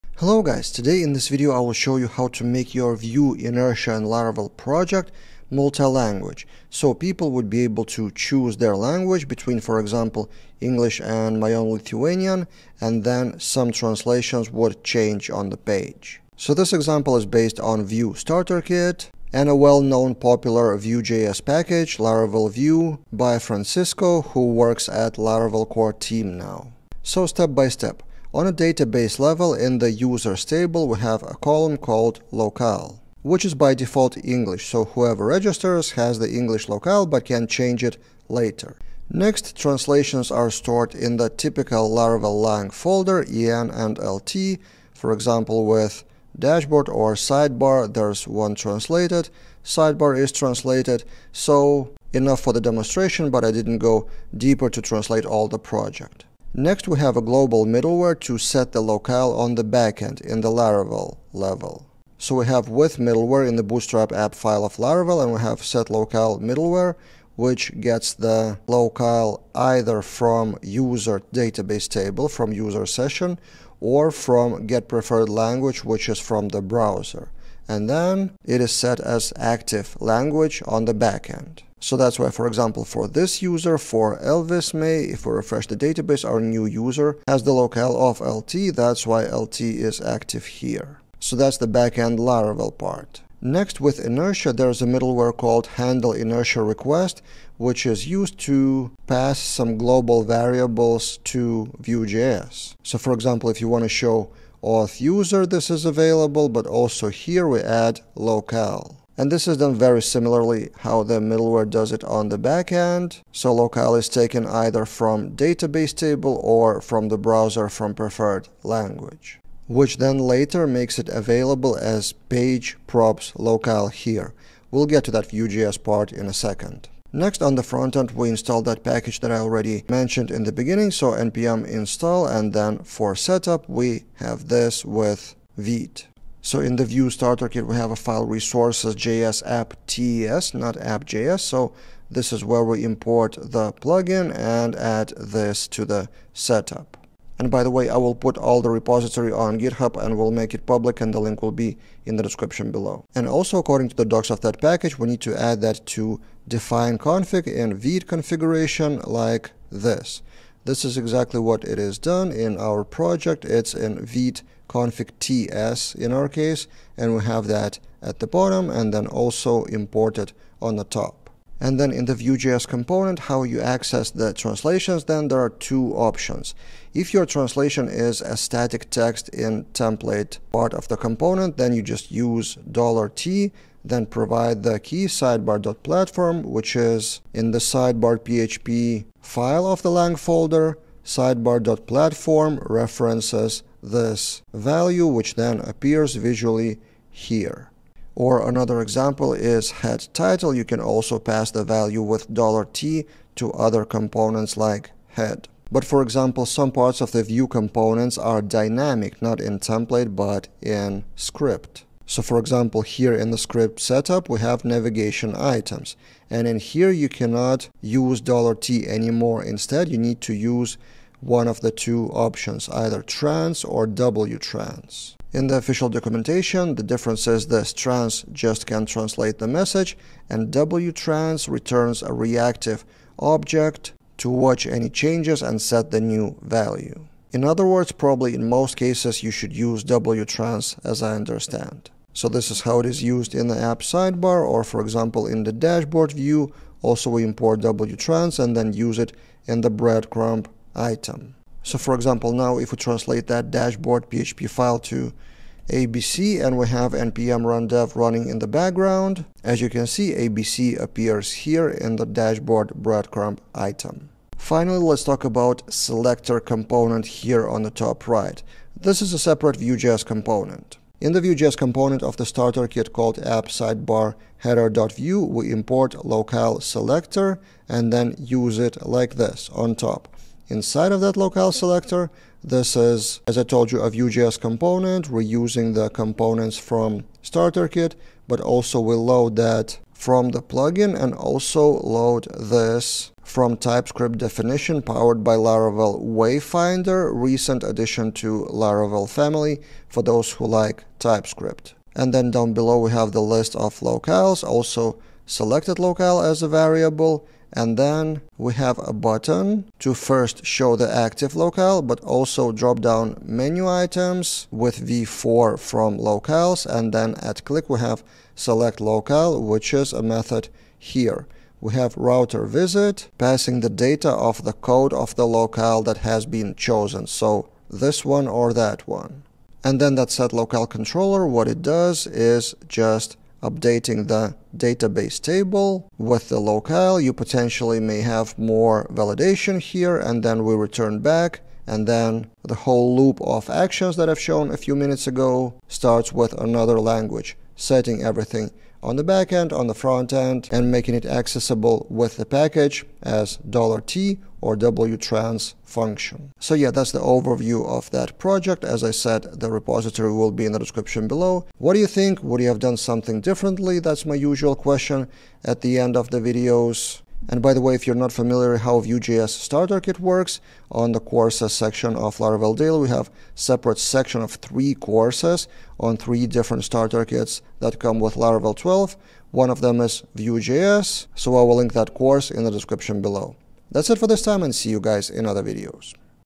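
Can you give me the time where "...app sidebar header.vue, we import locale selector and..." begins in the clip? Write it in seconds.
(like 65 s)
273 s.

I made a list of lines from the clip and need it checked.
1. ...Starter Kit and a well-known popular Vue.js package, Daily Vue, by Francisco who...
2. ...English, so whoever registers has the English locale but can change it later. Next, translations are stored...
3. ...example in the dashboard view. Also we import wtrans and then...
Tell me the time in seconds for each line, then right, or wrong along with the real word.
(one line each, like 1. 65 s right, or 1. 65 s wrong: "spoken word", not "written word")
1. 18 s wrong: "Laravel", not "Daily"
2. 34 s right
3. 244 s right.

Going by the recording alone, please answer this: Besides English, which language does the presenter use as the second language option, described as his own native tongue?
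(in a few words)
Lithuanian.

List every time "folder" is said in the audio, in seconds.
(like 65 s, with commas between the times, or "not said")
42 s, 190 s.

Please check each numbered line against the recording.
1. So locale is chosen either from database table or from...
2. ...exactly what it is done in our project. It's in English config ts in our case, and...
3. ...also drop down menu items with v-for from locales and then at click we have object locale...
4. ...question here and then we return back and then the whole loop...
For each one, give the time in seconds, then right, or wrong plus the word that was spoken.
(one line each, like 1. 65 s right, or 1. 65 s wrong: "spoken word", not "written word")
1. 113 s wrong: "taken", not "chosen"
2. 160 s wrong: "Vite", not "English"
3. 312 s wrong: "select", not "object"
4. 338 s wrong: "validation", not "question".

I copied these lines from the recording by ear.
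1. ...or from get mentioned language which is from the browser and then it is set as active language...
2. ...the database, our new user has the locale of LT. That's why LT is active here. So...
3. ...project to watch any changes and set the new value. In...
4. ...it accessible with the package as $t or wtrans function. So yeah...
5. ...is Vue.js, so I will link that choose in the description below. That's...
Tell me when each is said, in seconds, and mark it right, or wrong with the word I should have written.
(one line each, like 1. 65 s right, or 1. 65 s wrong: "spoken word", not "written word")
1. 73 s wrong: "preferred", not "mentioned"
2. 85 s right
3. 233 s wrong: "object", not "project"
4. 350 s right
5. 379 s wrong: "course", not "choose".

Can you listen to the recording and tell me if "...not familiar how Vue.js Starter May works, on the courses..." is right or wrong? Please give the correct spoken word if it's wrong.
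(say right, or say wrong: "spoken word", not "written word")
wrong: "Kit", not "May".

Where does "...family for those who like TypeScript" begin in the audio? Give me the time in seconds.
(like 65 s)
299 s.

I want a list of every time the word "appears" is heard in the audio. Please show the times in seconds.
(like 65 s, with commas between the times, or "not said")
195 s, 260 s.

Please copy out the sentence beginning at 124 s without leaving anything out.
We'll get to that Vue.js part in a second.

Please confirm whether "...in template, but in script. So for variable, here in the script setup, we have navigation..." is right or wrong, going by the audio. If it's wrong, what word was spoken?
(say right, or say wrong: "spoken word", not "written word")
wrong: "example", not "variable".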